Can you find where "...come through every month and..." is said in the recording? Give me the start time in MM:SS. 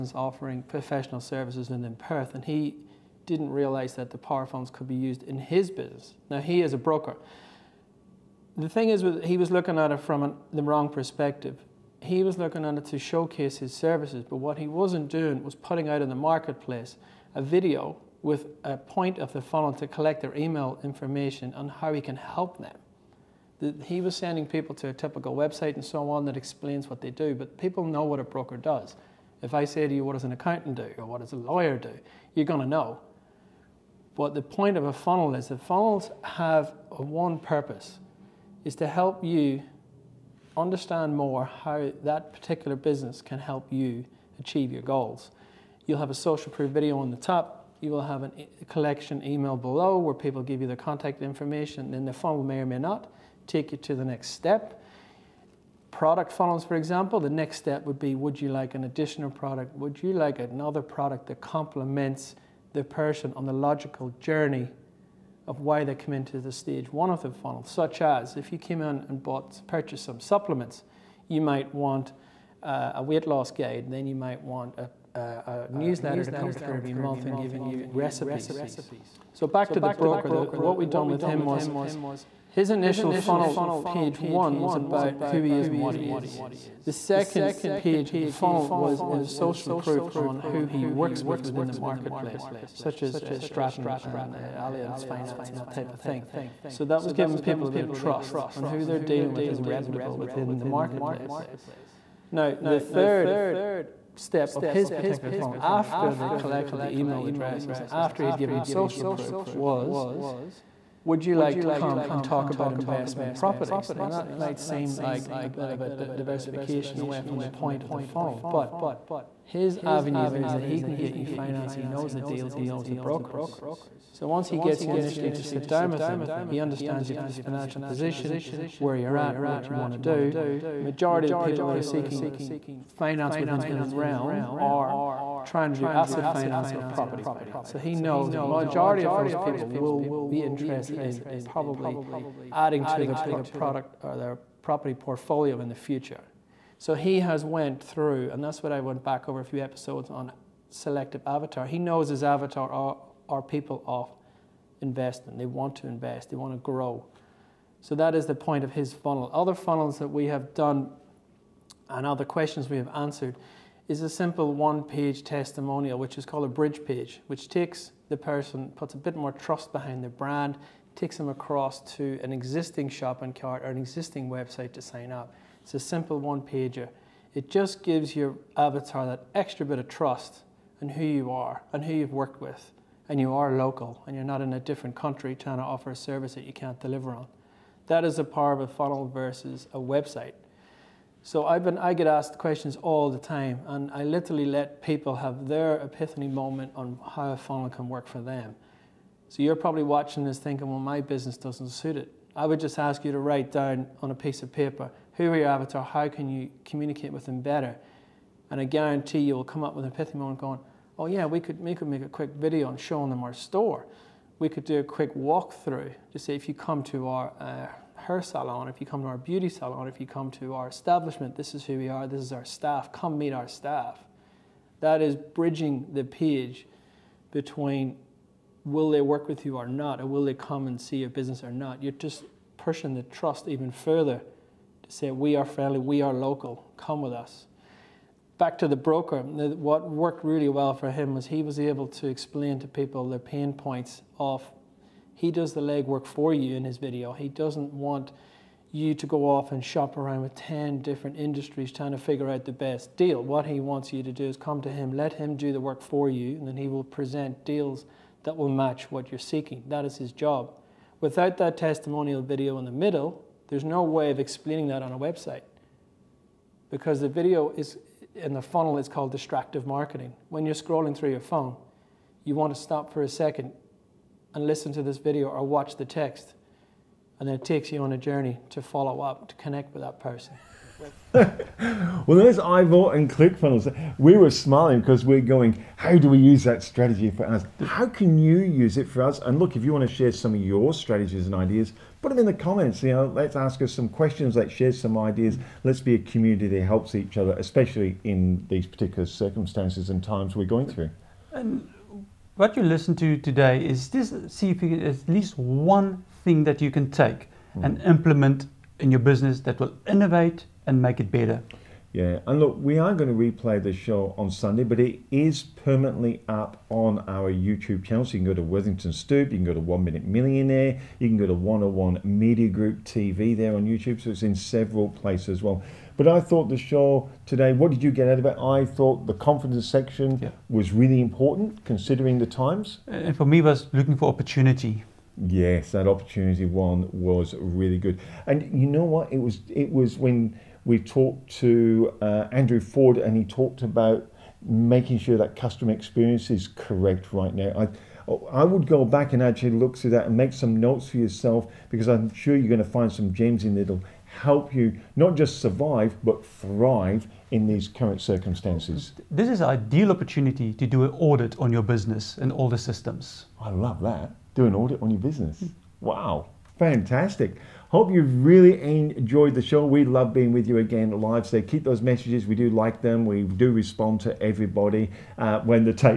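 01:16.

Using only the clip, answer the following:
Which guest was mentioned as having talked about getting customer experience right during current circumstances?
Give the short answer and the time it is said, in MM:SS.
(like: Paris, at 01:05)
Andrew Ford, at 05:42.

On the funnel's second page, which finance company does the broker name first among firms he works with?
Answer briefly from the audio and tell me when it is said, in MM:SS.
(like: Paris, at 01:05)
Stratton, at 01:33.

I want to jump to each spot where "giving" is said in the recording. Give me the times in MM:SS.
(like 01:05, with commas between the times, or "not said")
01:17, 01:37.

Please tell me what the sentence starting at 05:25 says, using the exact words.
But I thought the show today, what did you get out of it?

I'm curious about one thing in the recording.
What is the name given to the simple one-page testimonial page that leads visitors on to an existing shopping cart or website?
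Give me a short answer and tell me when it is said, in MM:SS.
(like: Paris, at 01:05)
bridge page, at 02:46.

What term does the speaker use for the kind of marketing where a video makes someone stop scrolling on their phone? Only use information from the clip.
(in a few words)
distractive marketing.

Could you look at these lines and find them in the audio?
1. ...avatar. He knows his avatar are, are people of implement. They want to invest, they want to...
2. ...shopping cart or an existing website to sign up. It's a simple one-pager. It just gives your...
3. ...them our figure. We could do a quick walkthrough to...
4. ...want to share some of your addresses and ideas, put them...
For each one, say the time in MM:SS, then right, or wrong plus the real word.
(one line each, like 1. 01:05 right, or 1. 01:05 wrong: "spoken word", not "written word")
1. 02:31 wrong: "investment", not "implement"
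2. 02:52 right
3. 03:33 wrong: "store", not "figure"
4. 04:49 wrong: "strategies", not "addresses".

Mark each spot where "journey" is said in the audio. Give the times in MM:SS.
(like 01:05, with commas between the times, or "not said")
01:04, 04:37.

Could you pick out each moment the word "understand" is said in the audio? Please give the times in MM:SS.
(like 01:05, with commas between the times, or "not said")
00:40, 02:06.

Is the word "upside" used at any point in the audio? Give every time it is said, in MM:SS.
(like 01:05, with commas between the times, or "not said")
not said.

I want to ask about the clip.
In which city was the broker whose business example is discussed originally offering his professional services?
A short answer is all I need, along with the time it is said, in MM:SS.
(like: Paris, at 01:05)
Perth, at 00:01.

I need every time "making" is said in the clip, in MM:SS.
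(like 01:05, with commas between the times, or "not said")
05:44.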